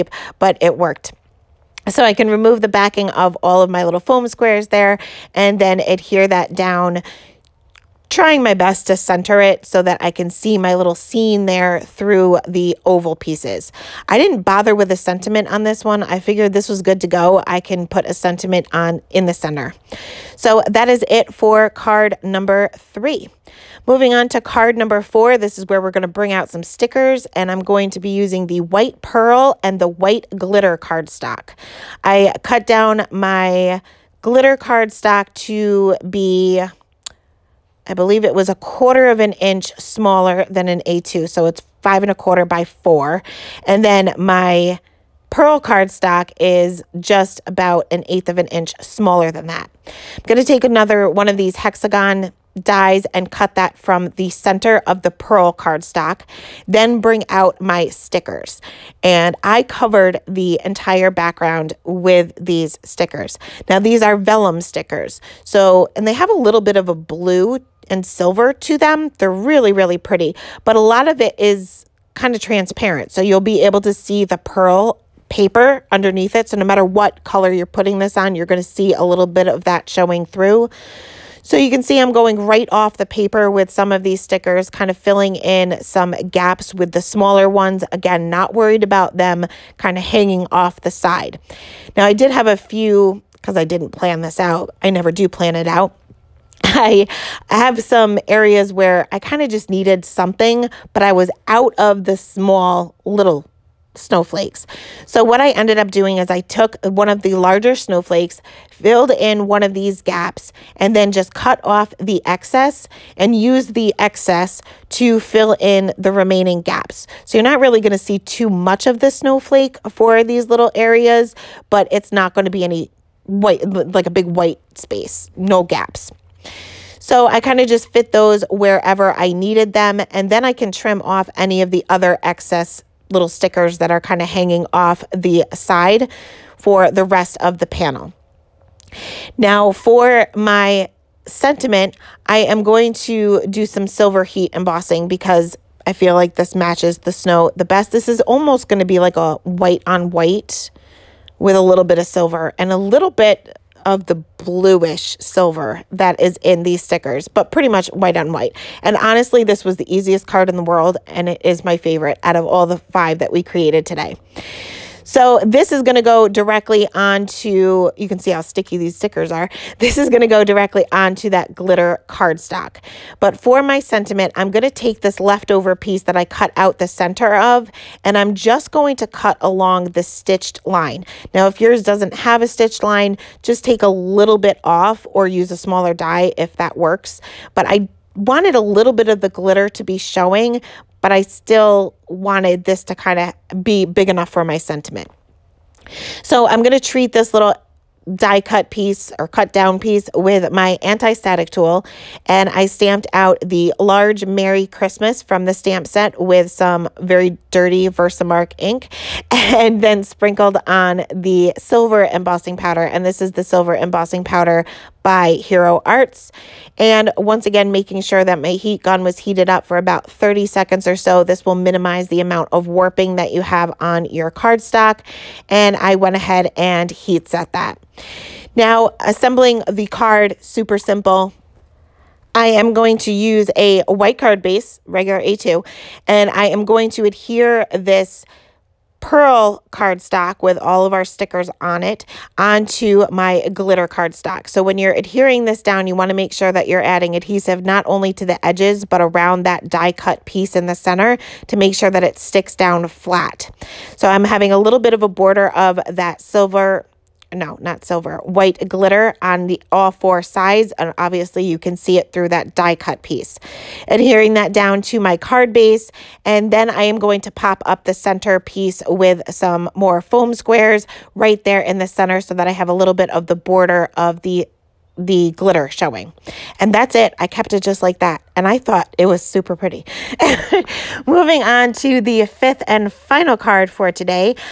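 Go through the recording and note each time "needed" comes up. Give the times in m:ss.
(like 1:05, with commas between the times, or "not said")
1:39, 2:09.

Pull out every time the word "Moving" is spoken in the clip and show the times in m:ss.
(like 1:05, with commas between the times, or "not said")
0:23, 4:41.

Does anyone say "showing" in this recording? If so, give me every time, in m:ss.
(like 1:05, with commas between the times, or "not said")
1:19, 3:09, 4:35.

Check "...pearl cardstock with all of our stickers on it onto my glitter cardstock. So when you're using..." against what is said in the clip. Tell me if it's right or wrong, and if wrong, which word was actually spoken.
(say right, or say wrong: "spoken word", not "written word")
wrong: "adhering", not "using".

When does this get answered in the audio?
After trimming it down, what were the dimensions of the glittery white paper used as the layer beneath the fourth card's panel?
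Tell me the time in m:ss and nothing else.
0:41.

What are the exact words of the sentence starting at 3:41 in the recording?
This will minimize the amount of warping that you have on your cardstock and I went ahead and heat set that.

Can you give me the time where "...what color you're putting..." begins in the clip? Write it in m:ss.
1:16.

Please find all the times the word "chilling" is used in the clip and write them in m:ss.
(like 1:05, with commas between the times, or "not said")
not said.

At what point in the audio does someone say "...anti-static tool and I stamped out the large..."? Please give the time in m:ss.
3:20.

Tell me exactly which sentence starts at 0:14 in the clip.
I didn't bother with a sentiment on this one.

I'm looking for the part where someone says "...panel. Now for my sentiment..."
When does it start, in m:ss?
2:17.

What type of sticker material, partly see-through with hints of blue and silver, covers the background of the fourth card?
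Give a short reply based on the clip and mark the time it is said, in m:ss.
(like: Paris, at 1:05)
Vellum, at 1:04.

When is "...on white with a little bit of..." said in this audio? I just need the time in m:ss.
2:29.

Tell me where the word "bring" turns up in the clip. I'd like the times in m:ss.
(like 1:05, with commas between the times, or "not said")
0:26, 0:57.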